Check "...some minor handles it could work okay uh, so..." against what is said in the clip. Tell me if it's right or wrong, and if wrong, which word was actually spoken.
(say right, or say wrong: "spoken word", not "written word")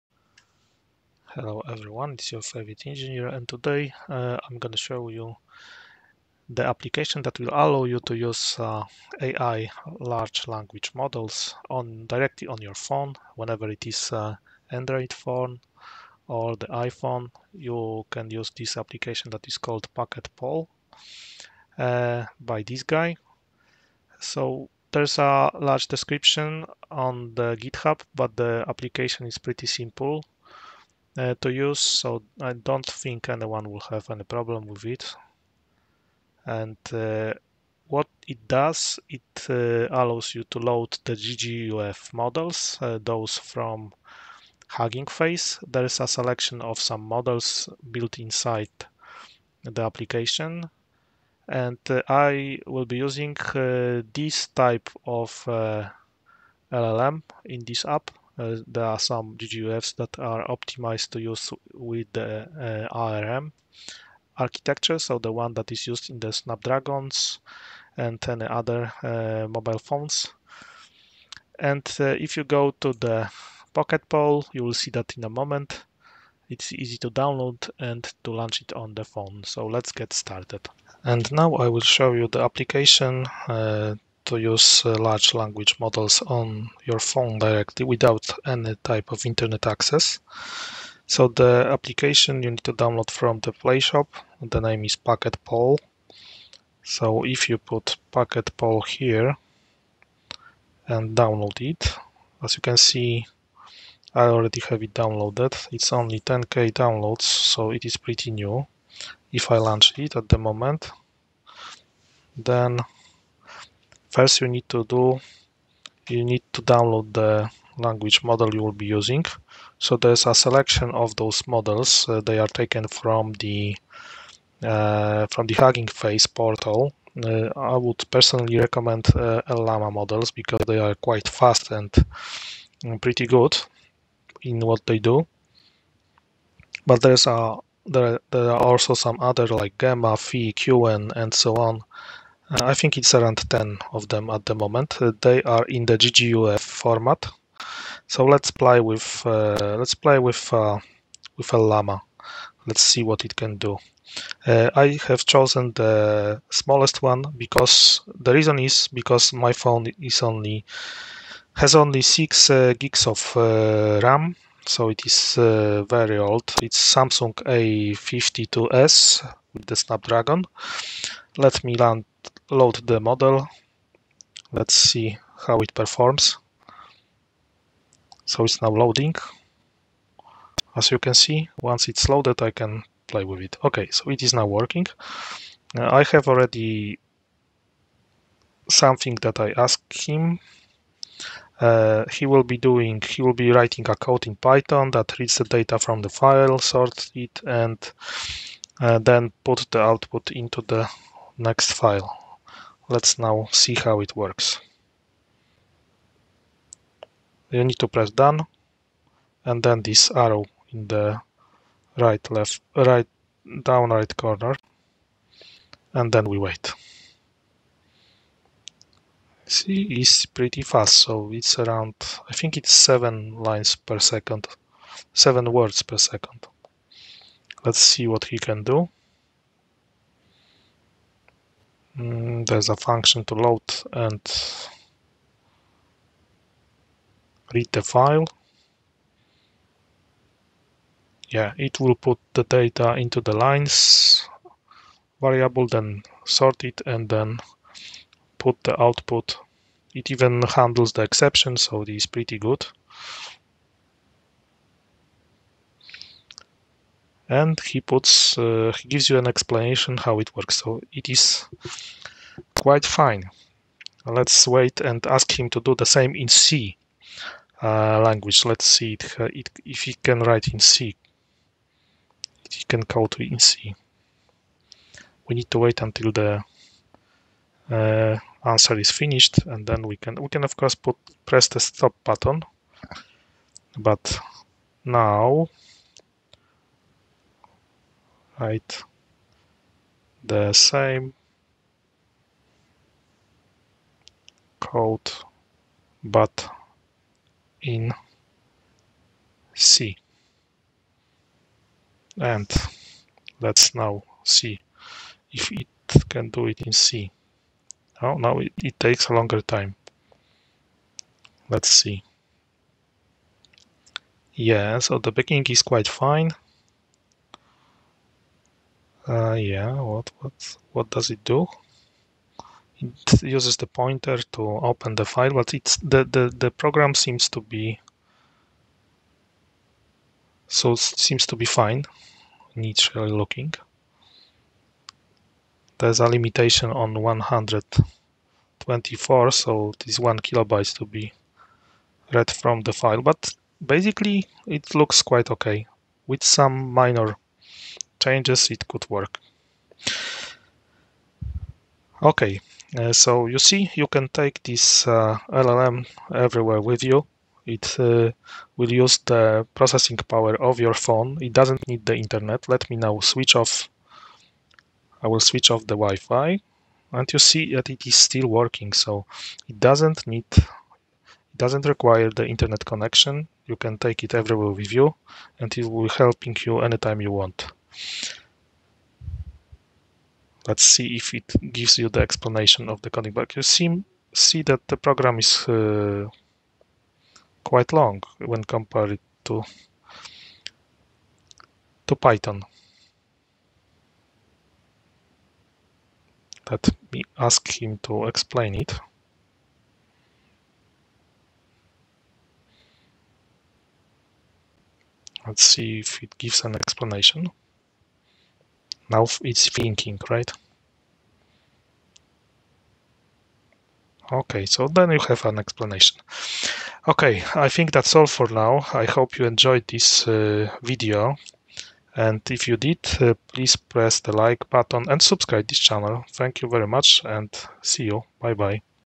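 wrong: "changes", not "handles".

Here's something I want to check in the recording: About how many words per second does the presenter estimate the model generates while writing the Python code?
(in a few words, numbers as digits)
7.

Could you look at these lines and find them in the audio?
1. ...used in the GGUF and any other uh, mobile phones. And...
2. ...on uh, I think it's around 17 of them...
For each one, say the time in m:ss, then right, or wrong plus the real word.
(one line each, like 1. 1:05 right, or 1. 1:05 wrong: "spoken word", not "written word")
1. 1:05 wrong: "Snapdragons", not "GGUF"
2. 2:21 wrong: "10", not "17".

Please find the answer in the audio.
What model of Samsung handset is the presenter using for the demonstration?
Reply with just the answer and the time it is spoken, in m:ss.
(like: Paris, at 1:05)
A52s, at 2:46.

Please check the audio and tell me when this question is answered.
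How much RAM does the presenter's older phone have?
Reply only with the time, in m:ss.
2:42.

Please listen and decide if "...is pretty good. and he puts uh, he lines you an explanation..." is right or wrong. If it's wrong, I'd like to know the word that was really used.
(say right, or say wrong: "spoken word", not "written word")
wrong: "gives", not "lines".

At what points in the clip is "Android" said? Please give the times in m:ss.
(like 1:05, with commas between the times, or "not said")
0:14.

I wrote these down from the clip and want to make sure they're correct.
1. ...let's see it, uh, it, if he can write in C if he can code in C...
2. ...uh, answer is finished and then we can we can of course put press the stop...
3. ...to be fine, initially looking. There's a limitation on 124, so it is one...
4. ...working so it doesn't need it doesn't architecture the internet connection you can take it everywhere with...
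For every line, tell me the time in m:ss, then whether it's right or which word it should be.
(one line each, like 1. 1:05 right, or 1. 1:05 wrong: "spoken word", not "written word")
1. 4:28 right
2. 4:37 right
3. 5:31 right
4. 6:08 wrong: "require", not "architecture".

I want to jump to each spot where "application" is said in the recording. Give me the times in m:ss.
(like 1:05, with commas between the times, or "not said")
0:06, 0:18, 0:28, 0:49, 1:22, 1:31.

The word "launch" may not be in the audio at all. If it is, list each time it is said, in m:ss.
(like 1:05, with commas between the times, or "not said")
1:18, 1:49.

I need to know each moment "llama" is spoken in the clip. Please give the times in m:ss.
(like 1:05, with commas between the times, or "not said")
2:09, 2:31.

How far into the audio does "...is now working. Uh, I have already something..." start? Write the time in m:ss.
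3:04.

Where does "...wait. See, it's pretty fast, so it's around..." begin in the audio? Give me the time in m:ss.
3:36.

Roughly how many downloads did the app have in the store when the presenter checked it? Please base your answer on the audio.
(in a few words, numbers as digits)
10k.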